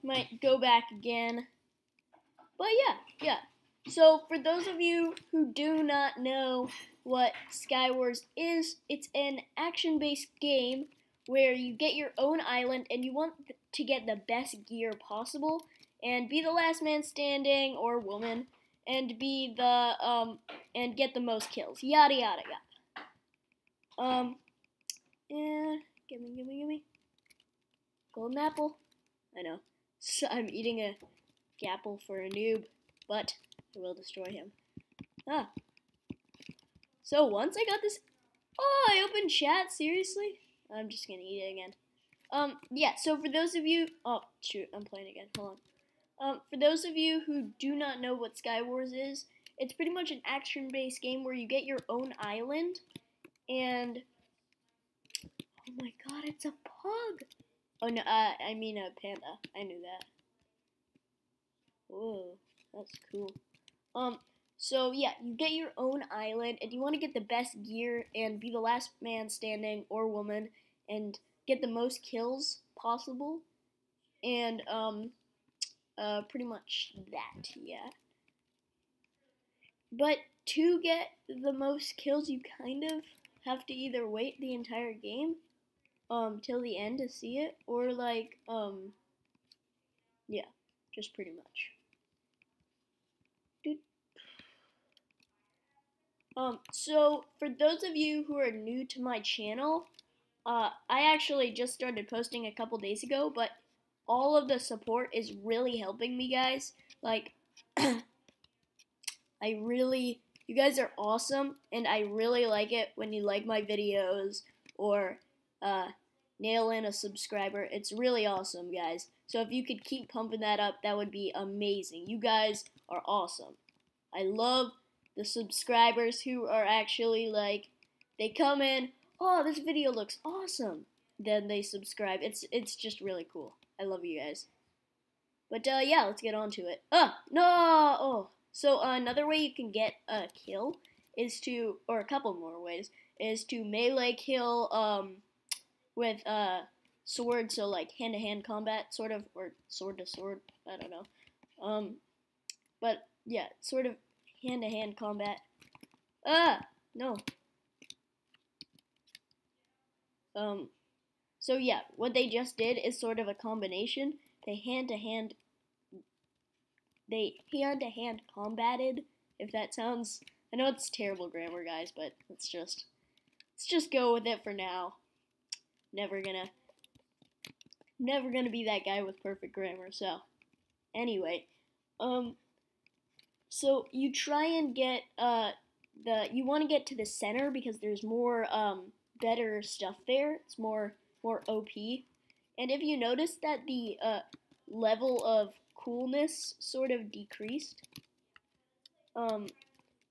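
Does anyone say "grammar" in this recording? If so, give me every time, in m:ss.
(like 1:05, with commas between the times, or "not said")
2:51, 2:59.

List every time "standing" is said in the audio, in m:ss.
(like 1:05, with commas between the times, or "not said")
0:17, 1:09.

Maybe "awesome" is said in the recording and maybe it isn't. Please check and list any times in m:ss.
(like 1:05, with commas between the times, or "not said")
1:50, 1:58, 2:03, 2:10.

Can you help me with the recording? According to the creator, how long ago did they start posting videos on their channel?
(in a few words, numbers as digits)
A couple days ago.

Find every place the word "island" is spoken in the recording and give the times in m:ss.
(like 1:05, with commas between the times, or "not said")
0:12, 0:52, 1:06.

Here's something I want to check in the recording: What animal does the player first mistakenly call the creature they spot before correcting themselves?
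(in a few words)
Pug.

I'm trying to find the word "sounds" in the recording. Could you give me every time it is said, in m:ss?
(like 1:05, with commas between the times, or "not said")
2:49.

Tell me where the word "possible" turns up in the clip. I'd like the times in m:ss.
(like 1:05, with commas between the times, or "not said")
0:15, 1:12.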